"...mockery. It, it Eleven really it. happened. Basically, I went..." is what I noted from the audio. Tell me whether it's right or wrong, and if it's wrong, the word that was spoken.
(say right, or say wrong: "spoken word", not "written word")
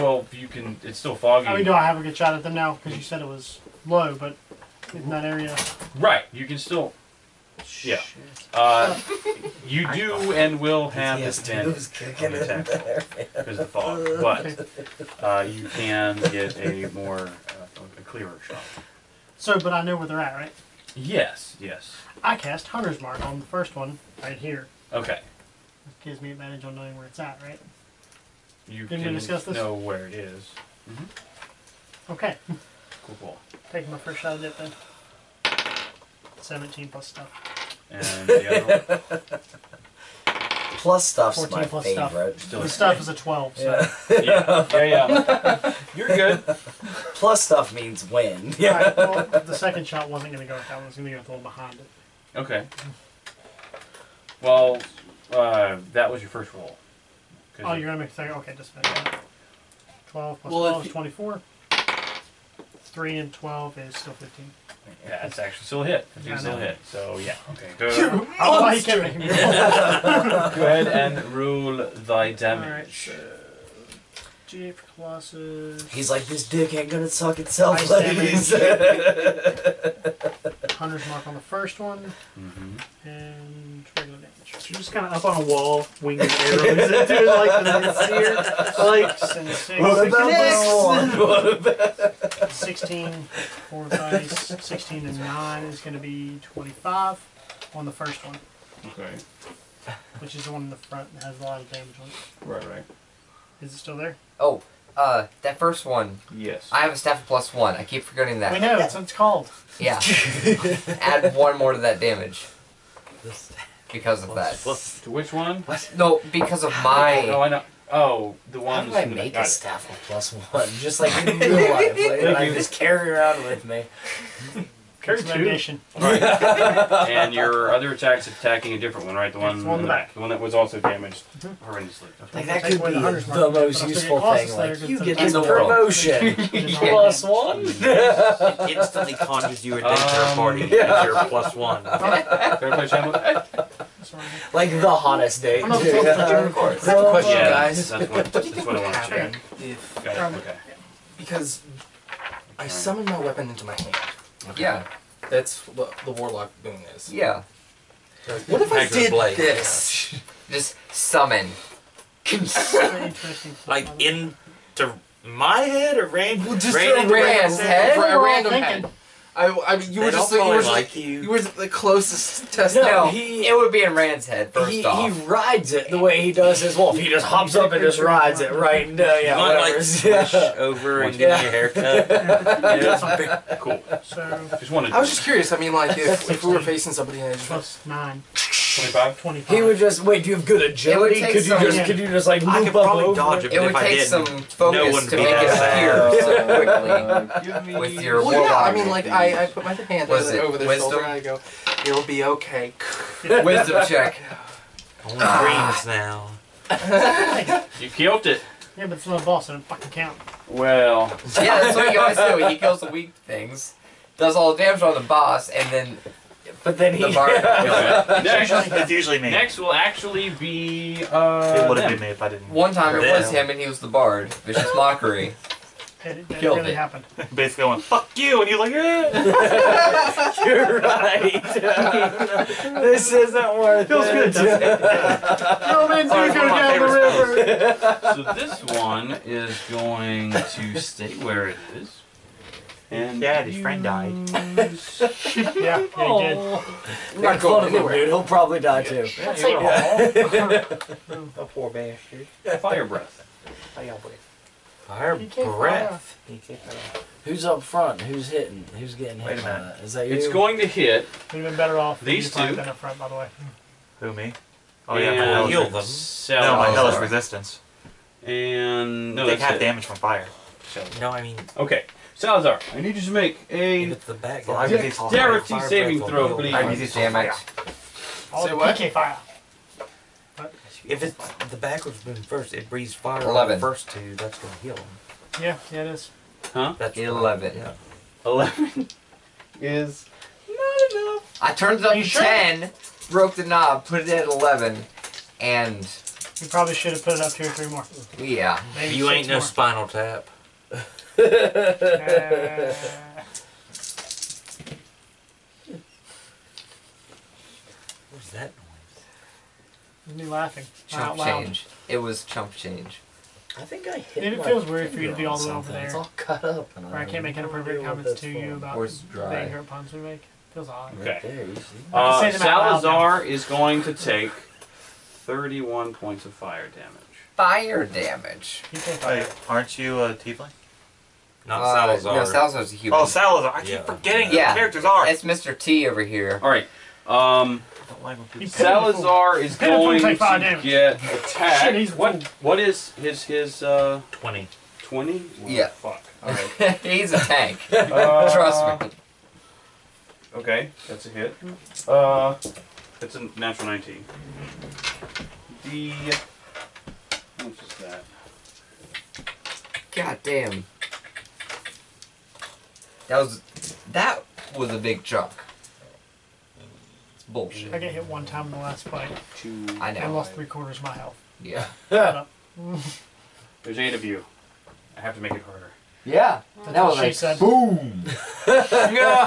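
wrong: "Killed", not "Eleven".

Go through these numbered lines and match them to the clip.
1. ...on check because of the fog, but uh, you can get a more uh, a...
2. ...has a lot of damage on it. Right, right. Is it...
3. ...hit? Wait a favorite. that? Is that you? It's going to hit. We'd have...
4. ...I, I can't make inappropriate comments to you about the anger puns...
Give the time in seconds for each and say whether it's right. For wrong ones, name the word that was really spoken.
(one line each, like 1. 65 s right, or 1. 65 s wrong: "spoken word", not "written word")
1. 11 s wrong: "attack", not "check"
2. 101 s right
3. 259 s wrong: "minute", not "favorite"
4. 316 s right.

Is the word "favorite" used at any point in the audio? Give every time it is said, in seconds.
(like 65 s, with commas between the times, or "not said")
42 s.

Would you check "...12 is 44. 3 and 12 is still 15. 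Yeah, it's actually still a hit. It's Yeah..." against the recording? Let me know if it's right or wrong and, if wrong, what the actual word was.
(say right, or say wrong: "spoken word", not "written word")
wrong: "24", not "44".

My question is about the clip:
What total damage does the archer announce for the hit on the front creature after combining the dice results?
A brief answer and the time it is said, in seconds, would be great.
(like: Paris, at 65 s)
25, at 94 s.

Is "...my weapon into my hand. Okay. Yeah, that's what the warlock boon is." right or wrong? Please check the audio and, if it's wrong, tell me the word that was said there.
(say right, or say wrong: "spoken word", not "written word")
right.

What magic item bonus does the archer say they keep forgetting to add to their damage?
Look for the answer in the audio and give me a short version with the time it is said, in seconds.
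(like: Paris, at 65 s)
Staff of plus one, at 106 s.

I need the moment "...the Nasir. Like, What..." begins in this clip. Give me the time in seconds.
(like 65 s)
87 s.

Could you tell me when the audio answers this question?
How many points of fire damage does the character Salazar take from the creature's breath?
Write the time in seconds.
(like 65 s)
324 s.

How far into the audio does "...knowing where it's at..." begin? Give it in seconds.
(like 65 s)
26 s.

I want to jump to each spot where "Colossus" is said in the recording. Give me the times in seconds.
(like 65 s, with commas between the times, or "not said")
74 s, 134 s.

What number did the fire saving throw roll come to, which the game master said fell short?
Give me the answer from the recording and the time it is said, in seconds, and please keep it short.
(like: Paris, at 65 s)
11, at 288 s.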